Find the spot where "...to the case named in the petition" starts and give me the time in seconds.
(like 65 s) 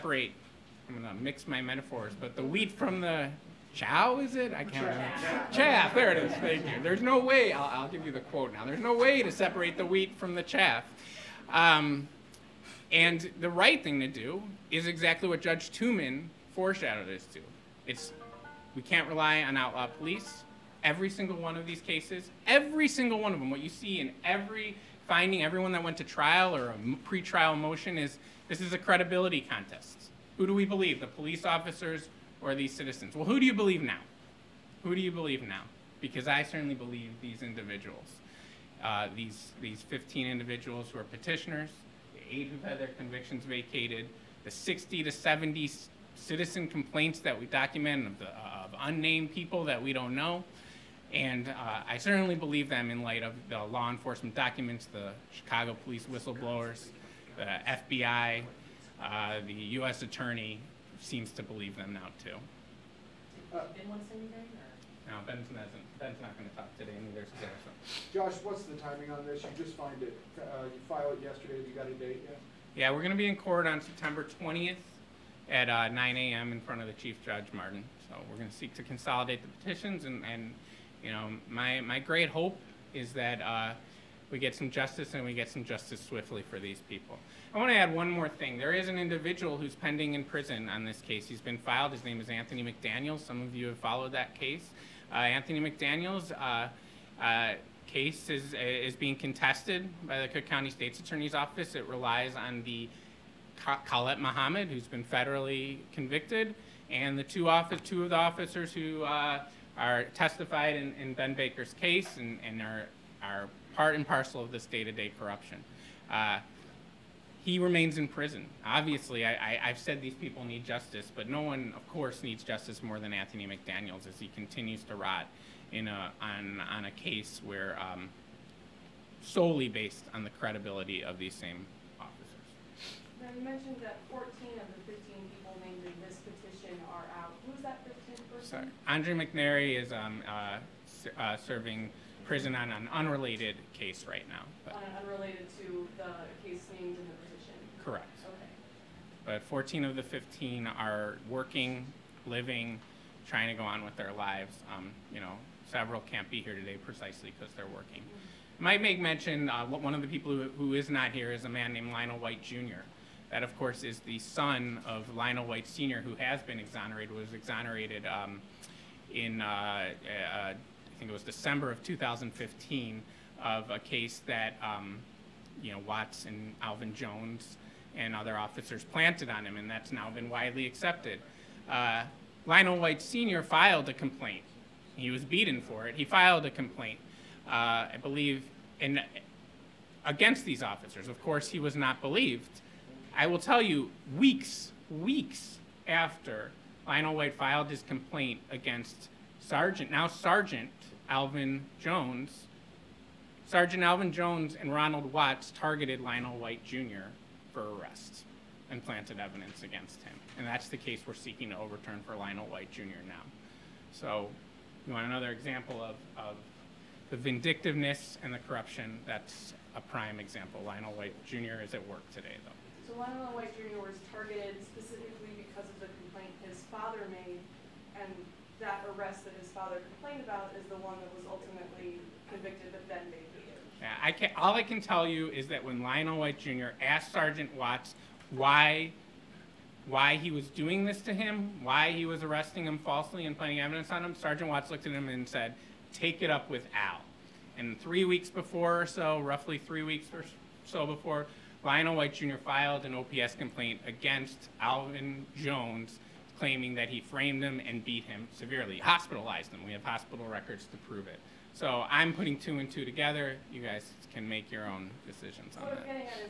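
145 s.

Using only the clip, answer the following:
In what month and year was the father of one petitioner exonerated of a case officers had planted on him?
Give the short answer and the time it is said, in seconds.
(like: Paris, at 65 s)
December 2015, at 171 s.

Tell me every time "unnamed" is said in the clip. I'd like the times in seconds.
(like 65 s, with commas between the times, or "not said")
48 s.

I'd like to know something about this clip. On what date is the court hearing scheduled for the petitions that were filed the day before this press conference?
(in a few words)
September 20th.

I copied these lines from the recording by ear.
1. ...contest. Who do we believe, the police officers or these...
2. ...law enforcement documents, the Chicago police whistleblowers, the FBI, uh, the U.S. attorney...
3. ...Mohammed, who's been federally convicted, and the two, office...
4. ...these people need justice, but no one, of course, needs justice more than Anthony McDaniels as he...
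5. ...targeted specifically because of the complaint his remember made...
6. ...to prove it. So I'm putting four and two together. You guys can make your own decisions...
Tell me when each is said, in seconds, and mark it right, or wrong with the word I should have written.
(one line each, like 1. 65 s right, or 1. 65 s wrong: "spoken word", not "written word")
1. 29 s right
2. 53 s right
3. 104 s right
4. 120 s right
5. 224 s wrong: "father", not "remember"
6. 260 s wrong: "two", not "four".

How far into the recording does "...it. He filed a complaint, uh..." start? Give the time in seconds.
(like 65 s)
185 s.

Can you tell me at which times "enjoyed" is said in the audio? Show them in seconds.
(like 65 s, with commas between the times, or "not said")
not said.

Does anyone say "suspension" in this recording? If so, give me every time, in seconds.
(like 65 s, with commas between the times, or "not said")
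not said.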